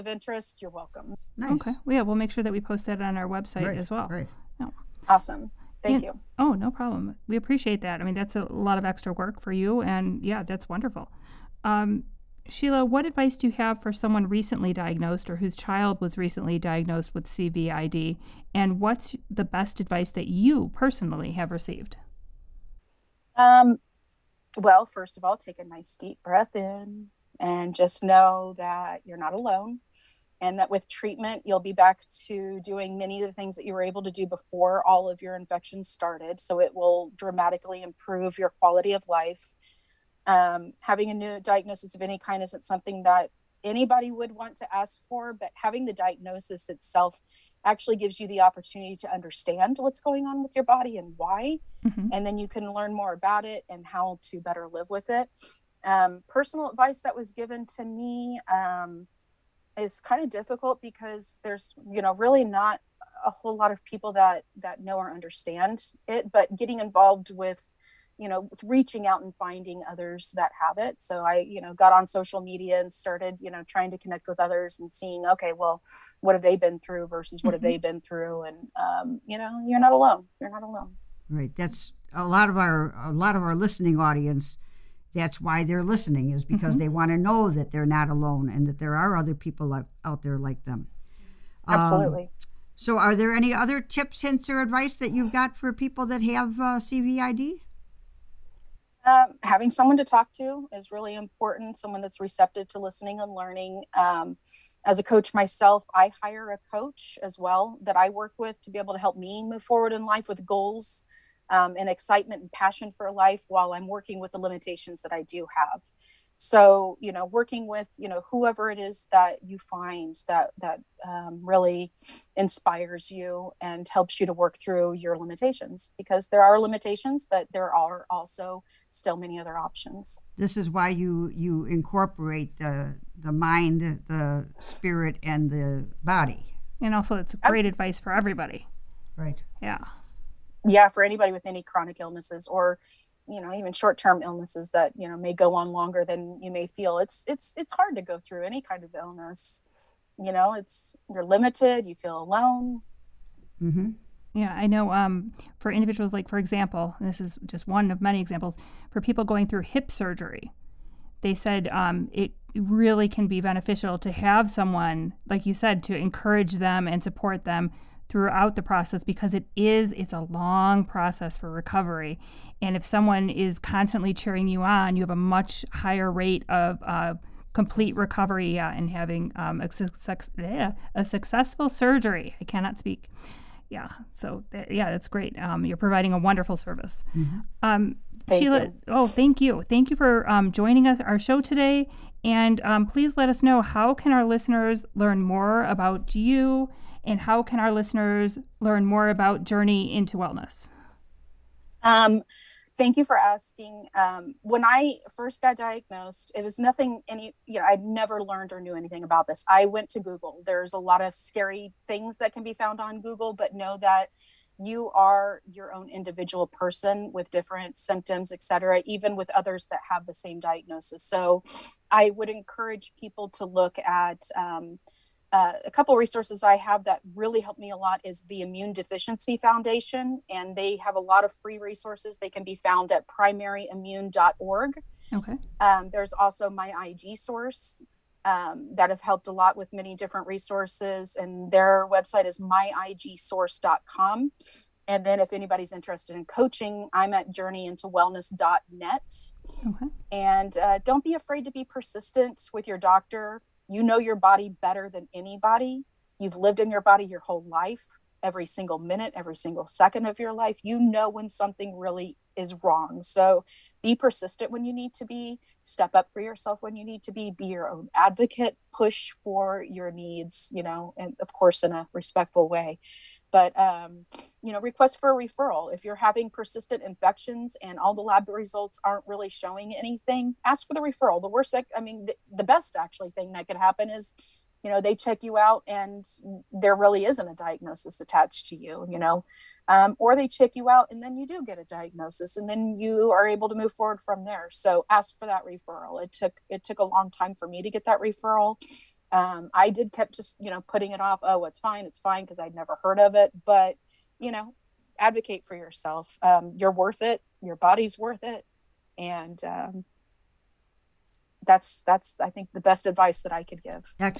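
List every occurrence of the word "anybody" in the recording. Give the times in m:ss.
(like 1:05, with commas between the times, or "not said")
0:43, 2:21, 4:05, 4:15.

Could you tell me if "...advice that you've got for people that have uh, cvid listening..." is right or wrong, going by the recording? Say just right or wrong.
wrong.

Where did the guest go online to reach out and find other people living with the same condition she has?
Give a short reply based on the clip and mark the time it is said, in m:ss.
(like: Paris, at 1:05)
social media, at 1:12.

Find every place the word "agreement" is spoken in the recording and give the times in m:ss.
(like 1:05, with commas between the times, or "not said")
not said.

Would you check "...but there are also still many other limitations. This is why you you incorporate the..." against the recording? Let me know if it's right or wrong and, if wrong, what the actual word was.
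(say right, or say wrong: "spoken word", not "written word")
wrong: "options", not "limitations".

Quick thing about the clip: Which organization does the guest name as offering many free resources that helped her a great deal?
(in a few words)
Immune Deficiency Foundation.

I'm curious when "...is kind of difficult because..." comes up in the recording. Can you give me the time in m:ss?
0:59.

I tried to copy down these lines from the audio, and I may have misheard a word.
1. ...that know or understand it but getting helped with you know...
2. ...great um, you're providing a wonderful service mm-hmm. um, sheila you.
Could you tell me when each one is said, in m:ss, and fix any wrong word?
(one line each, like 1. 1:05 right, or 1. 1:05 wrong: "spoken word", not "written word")
1. 1:04 wrong: "involved", not "helped"
2. 3:05 right.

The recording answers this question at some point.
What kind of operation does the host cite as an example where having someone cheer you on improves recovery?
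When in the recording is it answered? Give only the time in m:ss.
2:39.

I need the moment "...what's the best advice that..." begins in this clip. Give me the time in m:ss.
0:18.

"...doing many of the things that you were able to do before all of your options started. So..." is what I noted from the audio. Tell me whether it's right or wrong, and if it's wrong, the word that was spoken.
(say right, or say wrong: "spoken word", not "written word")
wrong: "infections", not "options".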